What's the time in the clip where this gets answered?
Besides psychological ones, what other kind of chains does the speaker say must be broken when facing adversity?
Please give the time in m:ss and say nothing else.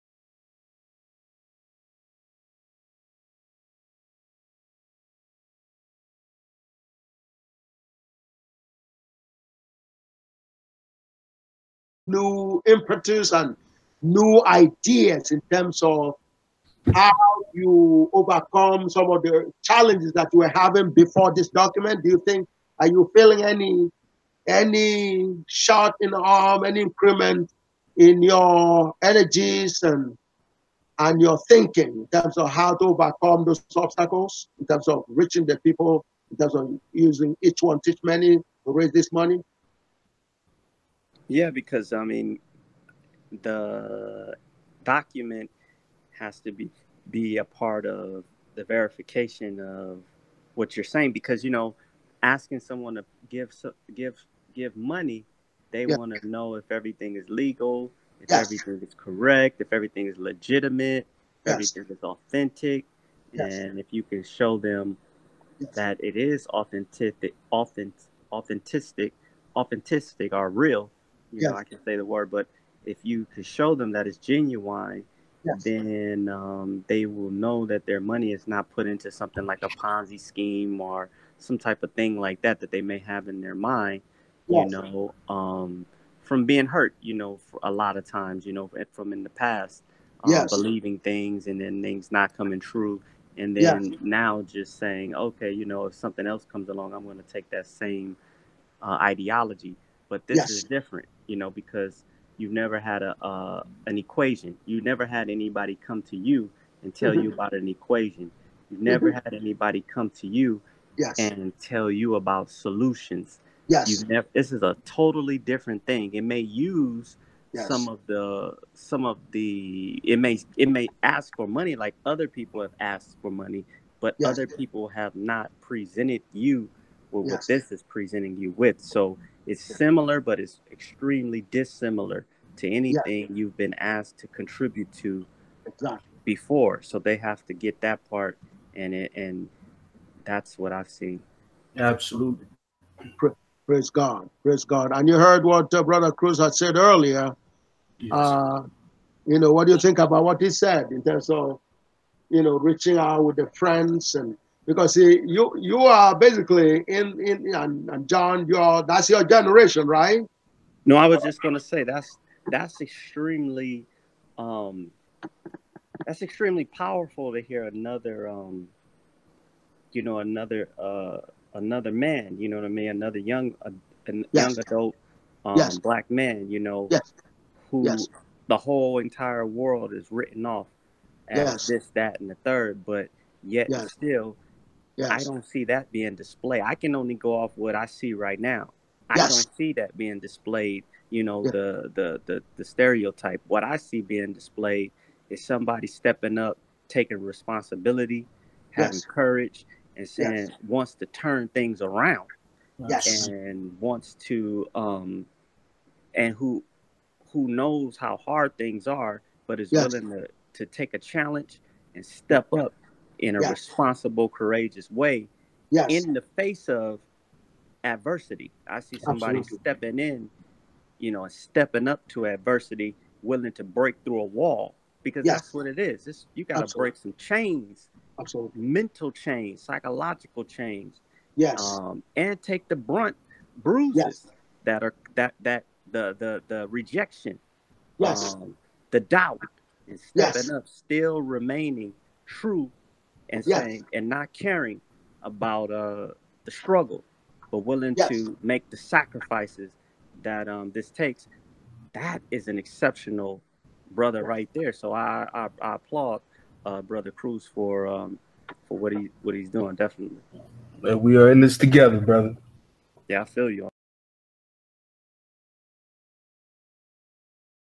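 3:48.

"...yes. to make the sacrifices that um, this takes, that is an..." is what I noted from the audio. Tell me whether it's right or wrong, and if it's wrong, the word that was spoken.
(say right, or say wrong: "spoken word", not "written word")
right.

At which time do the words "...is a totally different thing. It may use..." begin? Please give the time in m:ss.
1:54.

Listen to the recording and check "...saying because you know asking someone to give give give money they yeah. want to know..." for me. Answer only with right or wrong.
right.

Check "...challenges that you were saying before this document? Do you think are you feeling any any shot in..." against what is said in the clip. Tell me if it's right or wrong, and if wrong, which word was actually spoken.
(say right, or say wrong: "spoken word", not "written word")
wrong: "having", not "saying".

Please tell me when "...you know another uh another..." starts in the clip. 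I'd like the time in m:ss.
2:49.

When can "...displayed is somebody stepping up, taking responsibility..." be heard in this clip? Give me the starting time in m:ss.
3:14.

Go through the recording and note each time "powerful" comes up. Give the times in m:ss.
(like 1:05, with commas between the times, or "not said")
2:46.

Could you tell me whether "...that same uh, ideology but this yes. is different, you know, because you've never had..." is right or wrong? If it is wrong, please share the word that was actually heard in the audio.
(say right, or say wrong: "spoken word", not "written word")
right.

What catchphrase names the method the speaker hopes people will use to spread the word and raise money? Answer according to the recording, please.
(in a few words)
Each one, teach many.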